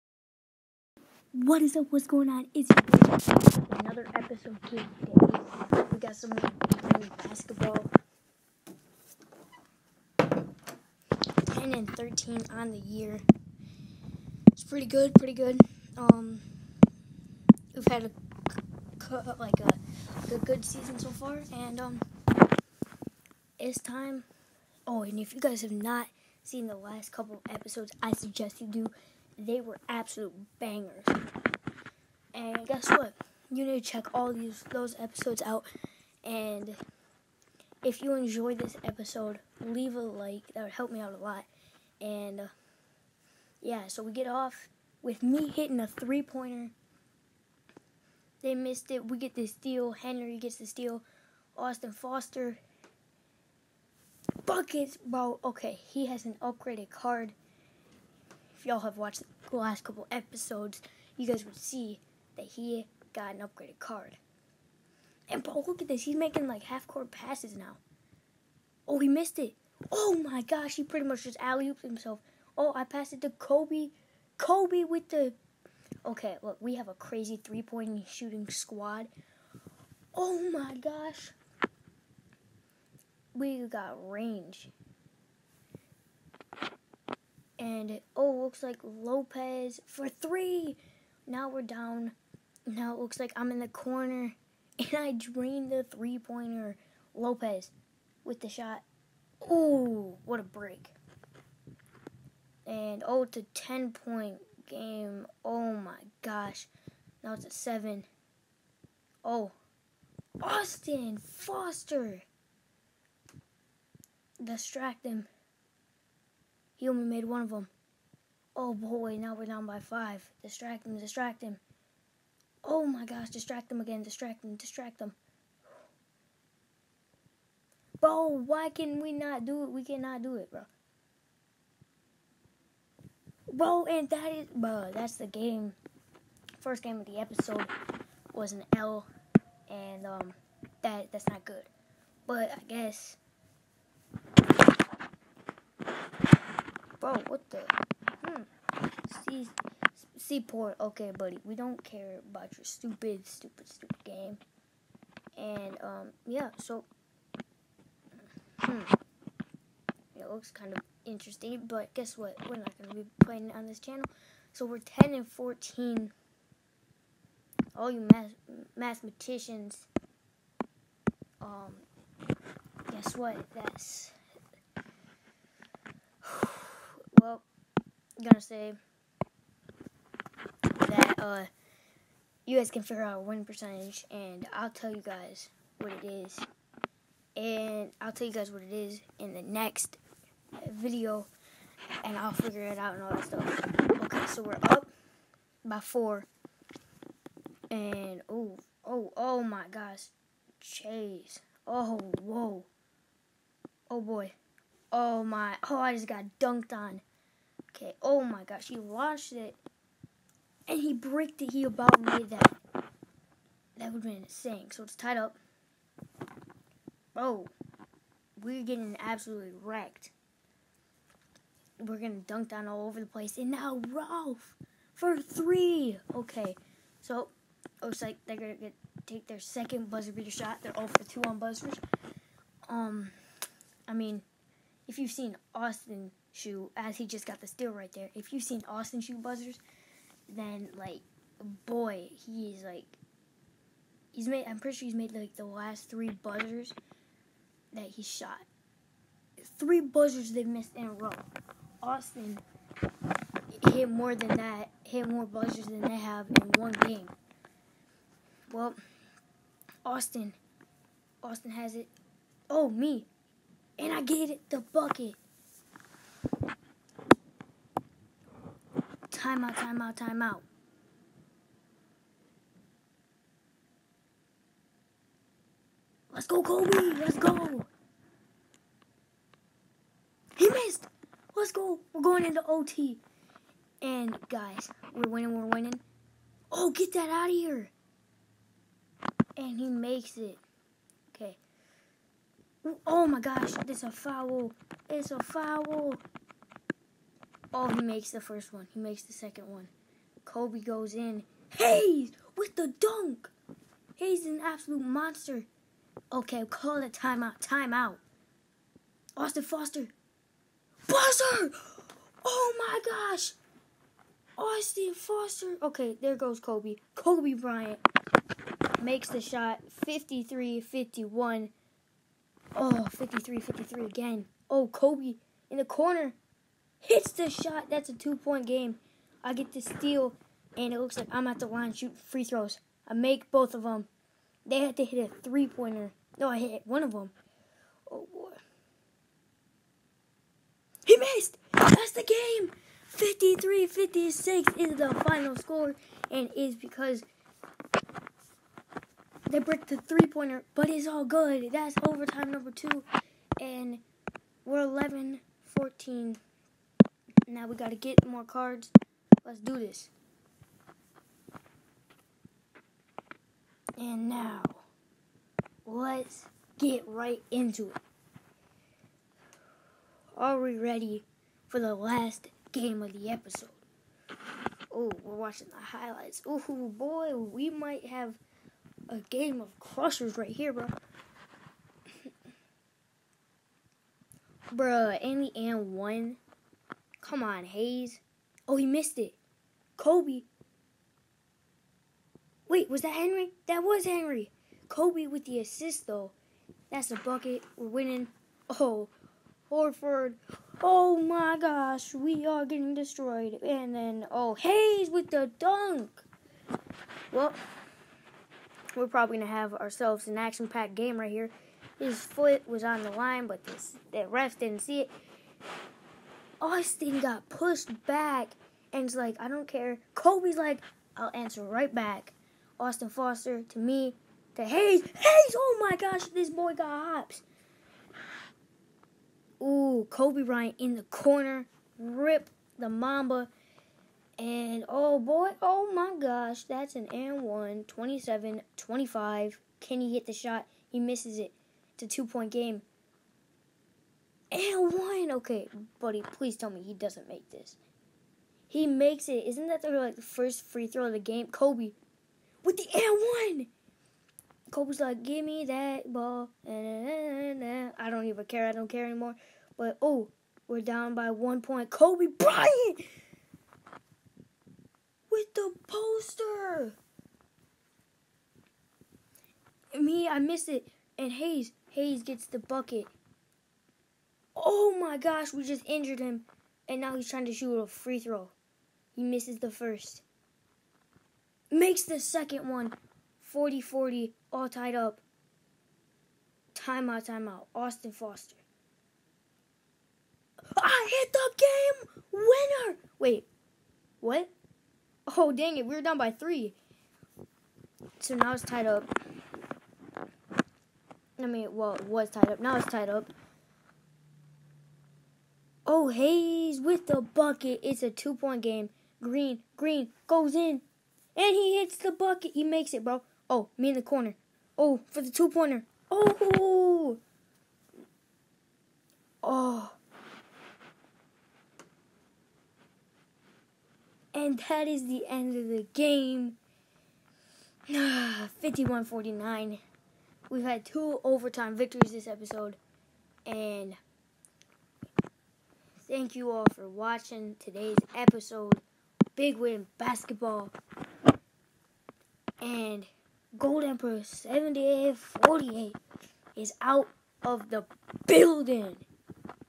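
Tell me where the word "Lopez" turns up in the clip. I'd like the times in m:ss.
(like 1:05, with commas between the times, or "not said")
1:28, 1:37.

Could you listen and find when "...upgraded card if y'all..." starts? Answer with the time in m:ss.
0:56.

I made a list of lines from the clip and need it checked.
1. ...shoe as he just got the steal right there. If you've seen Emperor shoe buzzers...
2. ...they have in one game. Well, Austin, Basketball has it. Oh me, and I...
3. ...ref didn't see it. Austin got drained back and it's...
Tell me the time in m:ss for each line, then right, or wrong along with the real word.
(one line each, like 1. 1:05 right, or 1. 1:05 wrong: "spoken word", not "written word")
1. 3:56 wrong: "Austin", not "Emperor"
2. 4:15 wrong: "Austin", not "Basketball"
3. 6:54 wrong: "pushed", not "drained".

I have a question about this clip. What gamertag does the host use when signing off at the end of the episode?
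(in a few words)
Gold Emperor 7848.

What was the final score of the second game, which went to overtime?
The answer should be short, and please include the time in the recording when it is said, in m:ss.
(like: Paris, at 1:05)
53-56, at 5:42.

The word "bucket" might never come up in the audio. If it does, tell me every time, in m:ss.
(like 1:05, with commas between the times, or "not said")
0:54, 4:24, 6:36, 7:52, 8:26, 8:31.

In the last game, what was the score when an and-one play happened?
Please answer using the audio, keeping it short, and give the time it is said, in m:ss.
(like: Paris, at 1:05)
27-25, at 7:17.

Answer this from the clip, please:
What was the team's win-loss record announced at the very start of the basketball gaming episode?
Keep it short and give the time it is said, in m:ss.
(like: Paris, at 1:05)
10-13, at 0:10.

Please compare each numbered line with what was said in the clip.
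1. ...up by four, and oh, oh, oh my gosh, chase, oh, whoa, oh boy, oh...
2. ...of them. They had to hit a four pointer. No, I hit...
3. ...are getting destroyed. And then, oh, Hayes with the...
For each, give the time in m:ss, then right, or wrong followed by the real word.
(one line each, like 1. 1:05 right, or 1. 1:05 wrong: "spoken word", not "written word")
1. 3:14 right
2. 5:33 wrong: "three", not "four"
3. 6:42 right.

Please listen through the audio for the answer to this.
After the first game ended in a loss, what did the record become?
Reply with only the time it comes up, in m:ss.
2:44.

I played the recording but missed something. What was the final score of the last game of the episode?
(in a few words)
51-49.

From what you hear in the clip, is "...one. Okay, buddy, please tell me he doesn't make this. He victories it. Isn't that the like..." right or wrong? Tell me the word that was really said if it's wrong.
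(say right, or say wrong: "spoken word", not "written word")
wrong: "makes", not "victories".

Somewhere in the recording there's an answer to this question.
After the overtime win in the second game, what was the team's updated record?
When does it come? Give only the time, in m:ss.
5:54.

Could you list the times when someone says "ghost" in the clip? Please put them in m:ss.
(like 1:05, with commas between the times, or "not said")
not said.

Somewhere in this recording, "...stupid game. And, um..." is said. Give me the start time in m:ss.
2:33.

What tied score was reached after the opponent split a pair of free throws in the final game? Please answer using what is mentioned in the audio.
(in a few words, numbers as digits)
40-40.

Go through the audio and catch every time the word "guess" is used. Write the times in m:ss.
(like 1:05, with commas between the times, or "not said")
0:32, 2:22, 2:41, 2:52.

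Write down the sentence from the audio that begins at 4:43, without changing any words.
And, guys, we're winning, we're winning.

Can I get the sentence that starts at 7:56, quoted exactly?
And now he's trying to shoot a free throw.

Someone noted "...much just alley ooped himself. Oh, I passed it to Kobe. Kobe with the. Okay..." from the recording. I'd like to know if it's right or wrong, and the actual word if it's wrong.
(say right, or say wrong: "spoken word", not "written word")
right.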